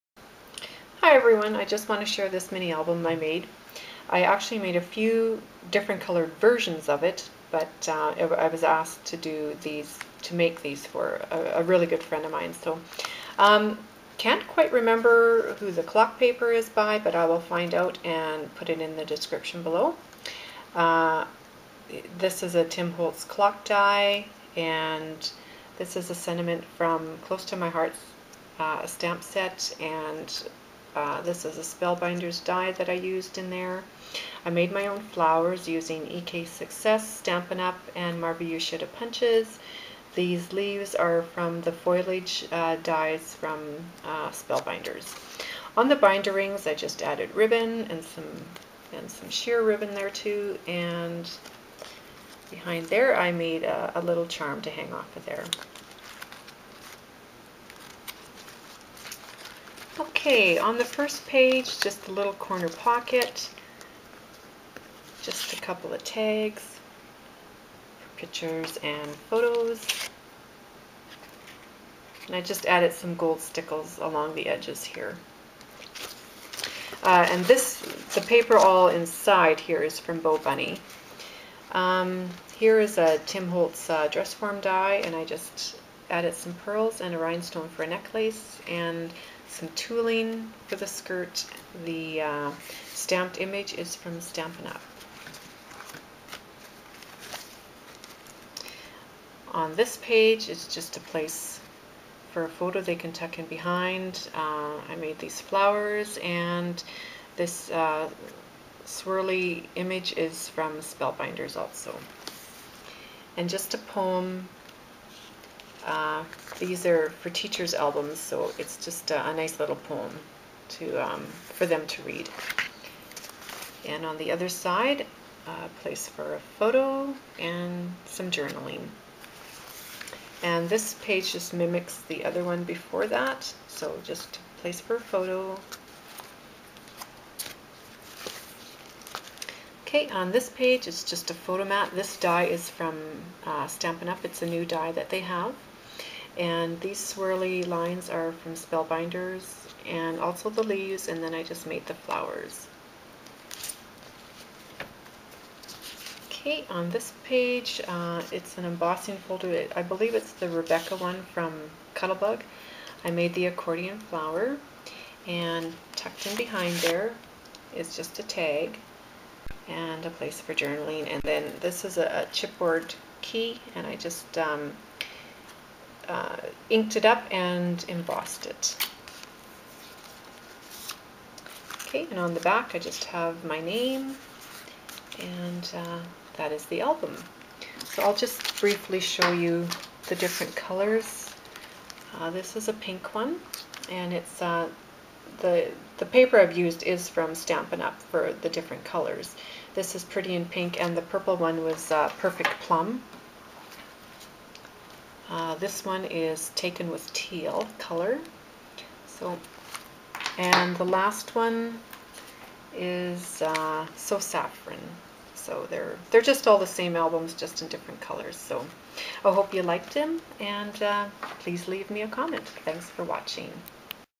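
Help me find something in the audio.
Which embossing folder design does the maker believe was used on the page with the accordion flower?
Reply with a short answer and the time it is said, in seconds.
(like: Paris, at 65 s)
Rebecca, at 160 s.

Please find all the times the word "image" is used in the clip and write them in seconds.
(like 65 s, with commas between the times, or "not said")
93 s, 109 s.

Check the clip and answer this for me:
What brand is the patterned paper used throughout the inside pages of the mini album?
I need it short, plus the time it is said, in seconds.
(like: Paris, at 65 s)
BoBunny, at 80 s.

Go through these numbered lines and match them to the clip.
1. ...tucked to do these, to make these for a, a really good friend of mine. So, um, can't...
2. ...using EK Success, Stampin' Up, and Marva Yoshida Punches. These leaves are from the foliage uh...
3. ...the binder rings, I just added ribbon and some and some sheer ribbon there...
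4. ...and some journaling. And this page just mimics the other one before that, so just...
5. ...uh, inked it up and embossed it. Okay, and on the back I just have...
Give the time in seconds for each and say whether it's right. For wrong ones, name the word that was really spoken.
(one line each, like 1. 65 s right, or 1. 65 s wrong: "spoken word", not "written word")
1. 8 s wrong: "asked", not "tucked"
2. 35 s right
3. 45 s right
4. 127 s right
5. 176 s right.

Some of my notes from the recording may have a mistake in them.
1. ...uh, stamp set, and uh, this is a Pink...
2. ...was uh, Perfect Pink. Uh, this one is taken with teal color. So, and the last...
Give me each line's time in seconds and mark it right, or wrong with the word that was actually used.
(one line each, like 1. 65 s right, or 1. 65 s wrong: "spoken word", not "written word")
1. 28 s wrong: "Spellbinders", not "Pink"
2. 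201 s wrong: "Plum", not "Pink".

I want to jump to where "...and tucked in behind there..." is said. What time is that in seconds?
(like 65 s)
165 s.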